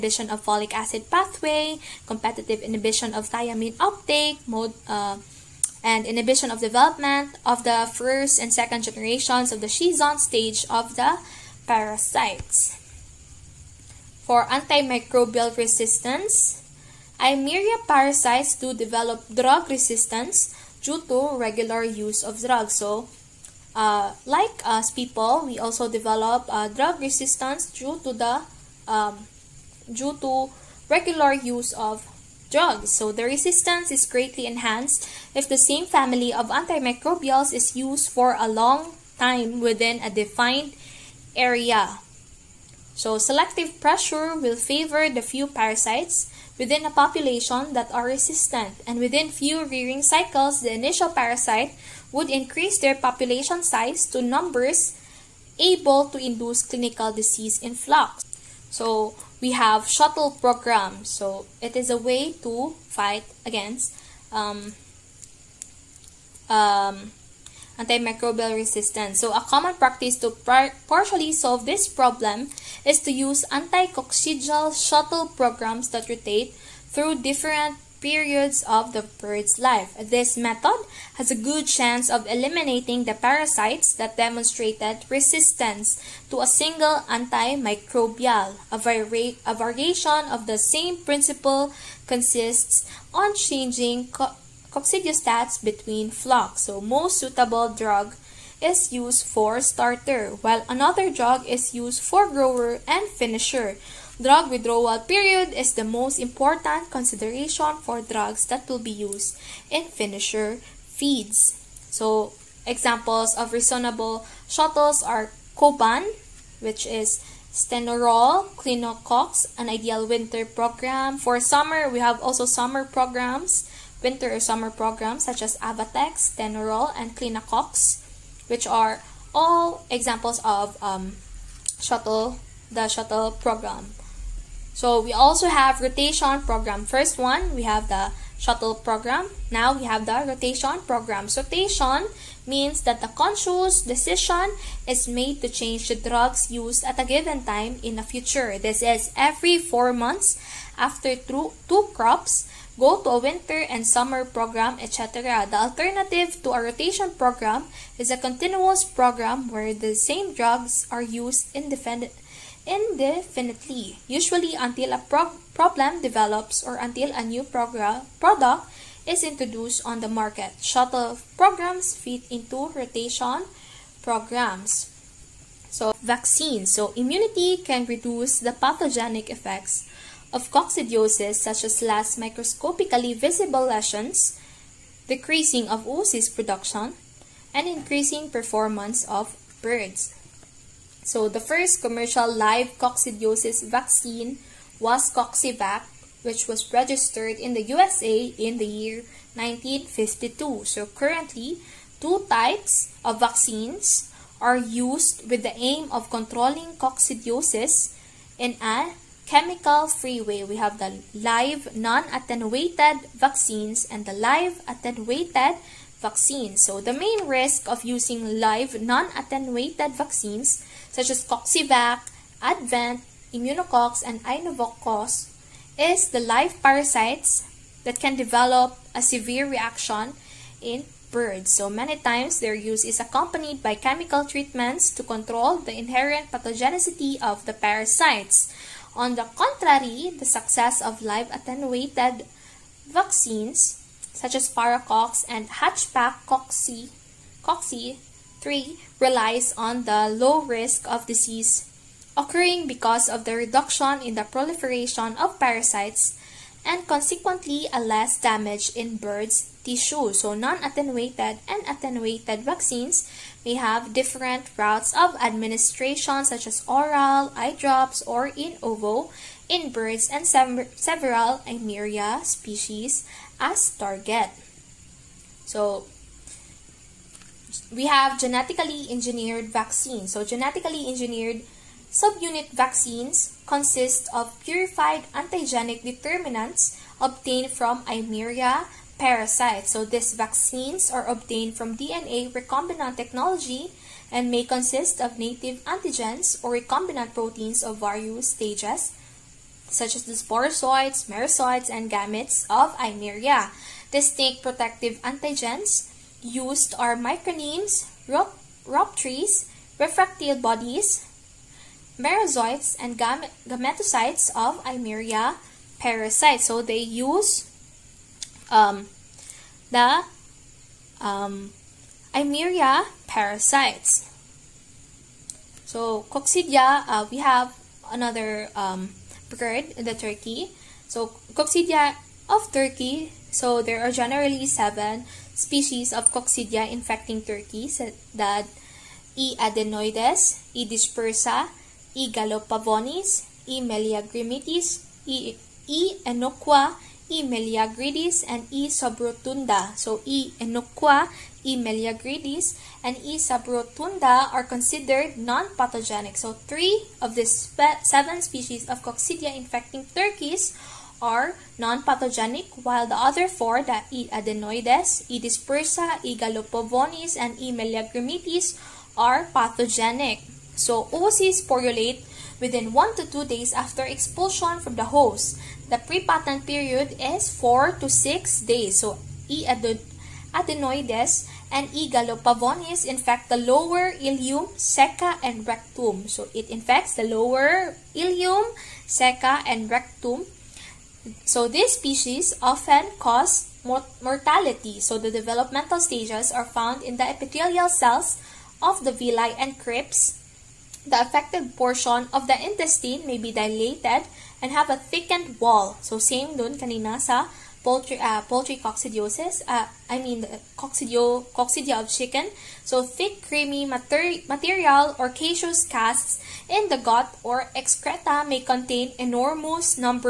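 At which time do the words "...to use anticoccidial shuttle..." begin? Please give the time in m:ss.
1:13.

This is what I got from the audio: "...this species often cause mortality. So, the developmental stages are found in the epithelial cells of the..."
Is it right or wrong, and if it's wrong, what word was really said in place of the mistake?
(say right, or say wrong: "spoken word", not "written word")
right.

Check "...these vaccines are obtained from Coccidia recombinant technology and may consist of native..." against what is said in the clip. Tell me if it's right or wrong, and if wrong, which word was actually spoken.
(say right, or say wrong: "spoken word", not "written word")
wrong: "DNA", not "Coccidia".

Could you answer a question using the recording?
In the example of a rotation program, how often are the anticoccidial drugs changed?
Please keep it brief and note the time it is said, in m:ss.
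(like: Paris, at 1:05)
every four months, at 2:29.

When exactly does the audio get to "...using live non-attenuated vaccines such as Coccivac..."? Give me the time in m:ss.
3:37.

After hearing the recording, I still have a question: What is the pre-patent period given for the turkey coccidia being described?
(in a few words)
4 to 6 days.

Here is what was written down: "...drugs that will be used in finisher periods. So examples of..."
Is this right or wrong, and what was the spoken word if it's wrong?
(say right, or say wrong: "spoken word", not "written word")
wrong: "feeds", not "periods".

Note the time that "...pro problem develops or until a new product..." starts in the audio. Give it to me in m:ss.
2:45.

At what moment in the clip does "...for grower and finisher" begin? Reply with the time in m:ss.
1:42.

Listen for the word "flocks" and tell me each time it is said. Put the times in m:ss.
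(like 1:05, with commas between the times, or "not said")
0:57, 1:36.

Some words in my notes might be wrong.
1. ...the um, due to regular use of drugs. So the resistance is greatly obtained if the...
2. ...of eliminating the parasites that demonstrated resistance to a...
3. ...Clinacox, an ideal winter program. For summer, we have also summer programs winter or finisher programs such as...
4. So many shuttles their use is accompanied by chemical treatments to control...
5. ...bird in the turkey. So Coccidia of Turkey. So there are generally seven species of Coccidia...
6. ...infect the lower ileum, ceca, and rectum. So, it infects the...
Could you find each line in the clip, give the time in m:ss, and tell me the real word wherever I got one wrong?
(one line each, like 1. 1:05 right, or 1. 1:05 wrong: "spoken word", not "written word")
1. 0:28 wrong: "enhanced", not "obtained"
2. 1:22 right
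3. 1:58 wrong: "summer", not "finisher"
4. 3:51 wrong: "times", not "shuttles"
5. 5:29 right
6. 6:22 right.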